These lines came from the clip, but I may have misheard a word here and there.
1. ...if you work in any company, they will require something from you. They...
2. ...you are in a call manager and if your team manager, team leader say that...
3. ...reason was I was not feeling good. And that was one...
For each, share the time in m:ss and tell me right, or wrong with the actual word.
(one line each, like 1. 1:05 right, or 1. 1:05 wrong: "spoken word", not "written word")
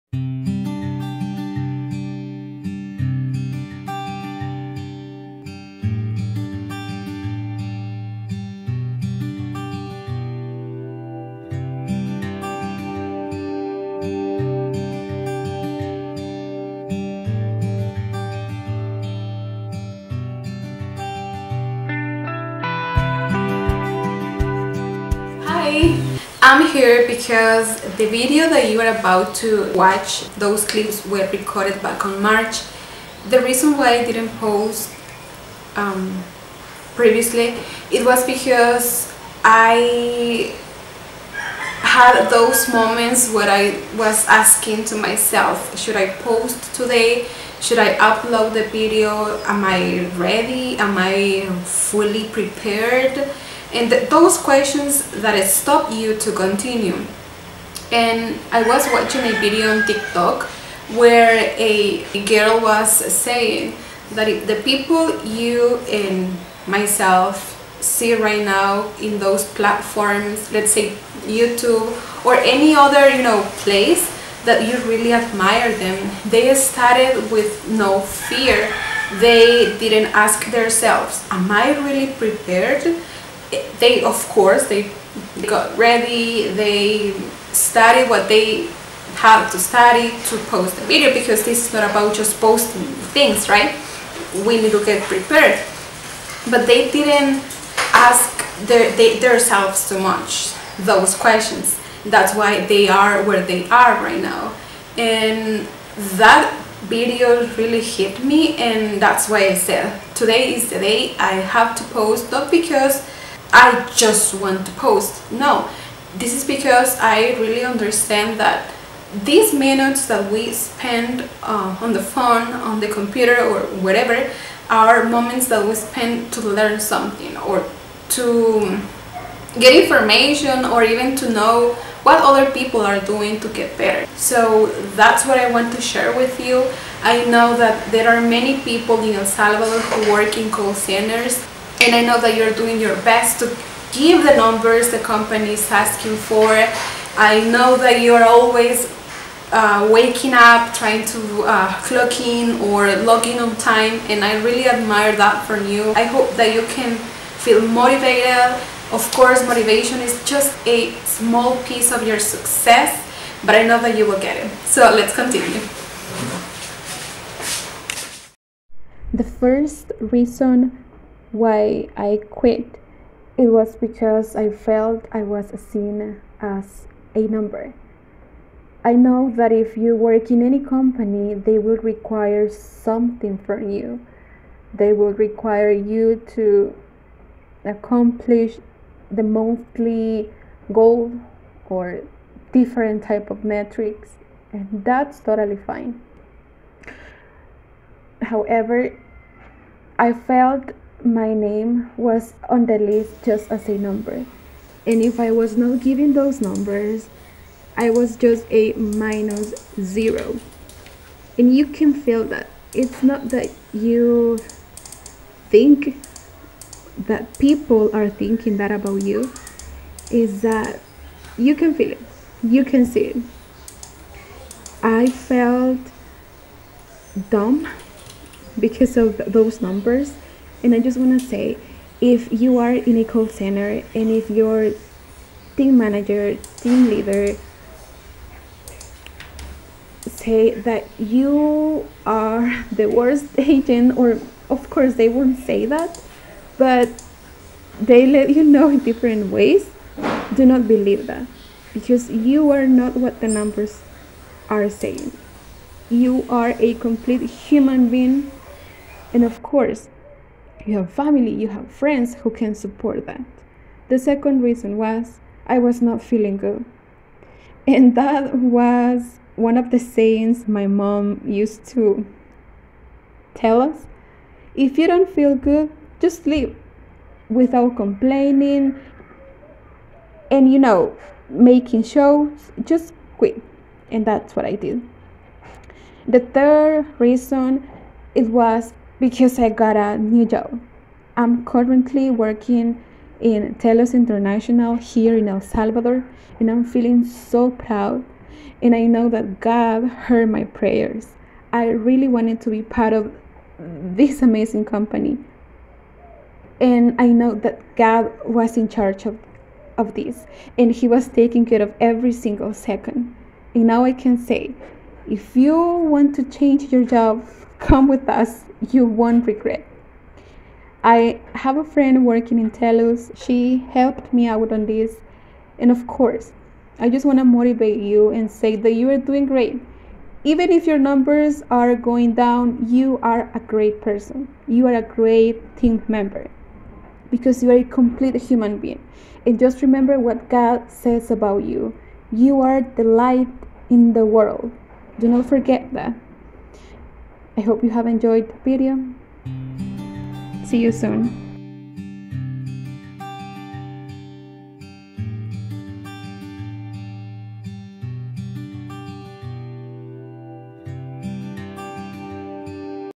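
1. 2:59 right
2. 3:52 wrong: "center", not "manager"
3. 4:24 right.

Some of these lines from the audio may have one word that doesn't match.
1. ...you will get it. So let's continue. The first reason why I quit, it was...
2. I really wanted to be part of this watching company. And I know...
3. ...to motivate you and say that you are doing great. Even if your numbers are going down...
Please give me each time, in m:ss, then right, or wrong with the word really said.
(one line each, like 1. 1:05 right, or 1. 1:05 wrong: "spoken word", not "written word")
1. 2:43 right
2. 5:01 wrong: "amazing", not "watching"
3. 5:27 right.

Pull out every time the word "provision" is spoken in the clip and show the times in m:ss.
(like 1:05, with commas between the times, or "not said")
not said.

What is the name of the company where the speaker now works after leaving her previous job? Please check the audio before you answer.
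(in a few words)
Telus International.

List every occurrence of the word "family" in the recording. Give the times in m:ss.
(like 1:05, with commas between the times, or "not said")
4:20.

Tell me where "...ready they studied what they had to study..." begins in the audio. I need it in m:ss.
1:25.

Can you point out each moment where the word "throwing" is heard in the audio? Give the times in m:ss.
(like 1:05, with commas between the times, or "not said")
not said.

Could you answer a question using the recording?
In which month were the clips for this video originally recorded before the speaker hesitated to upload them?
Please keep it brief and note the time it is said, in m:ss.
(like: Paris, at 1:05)
March, at 0:32.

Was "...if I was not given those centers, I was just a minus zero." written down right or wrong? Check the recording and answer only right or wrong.
wrong.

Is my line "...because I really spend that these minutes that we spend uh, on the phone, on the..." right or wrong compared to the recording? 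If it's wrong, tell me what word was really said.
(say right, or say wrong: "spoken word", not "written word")
wrong: "understand", not "spend".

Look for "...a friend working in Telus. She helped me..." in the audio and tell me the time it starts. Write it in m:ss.
5:21.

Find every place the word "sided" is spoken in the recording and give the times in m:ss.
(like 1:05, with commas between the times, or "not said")
not said.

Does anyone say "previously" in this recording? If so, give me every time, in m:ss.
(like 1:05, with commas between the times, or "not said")
0:36.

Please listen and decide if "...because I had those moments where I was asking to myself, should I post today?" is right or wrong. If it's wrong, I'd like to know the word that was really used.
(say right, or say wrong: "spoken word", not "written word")
right.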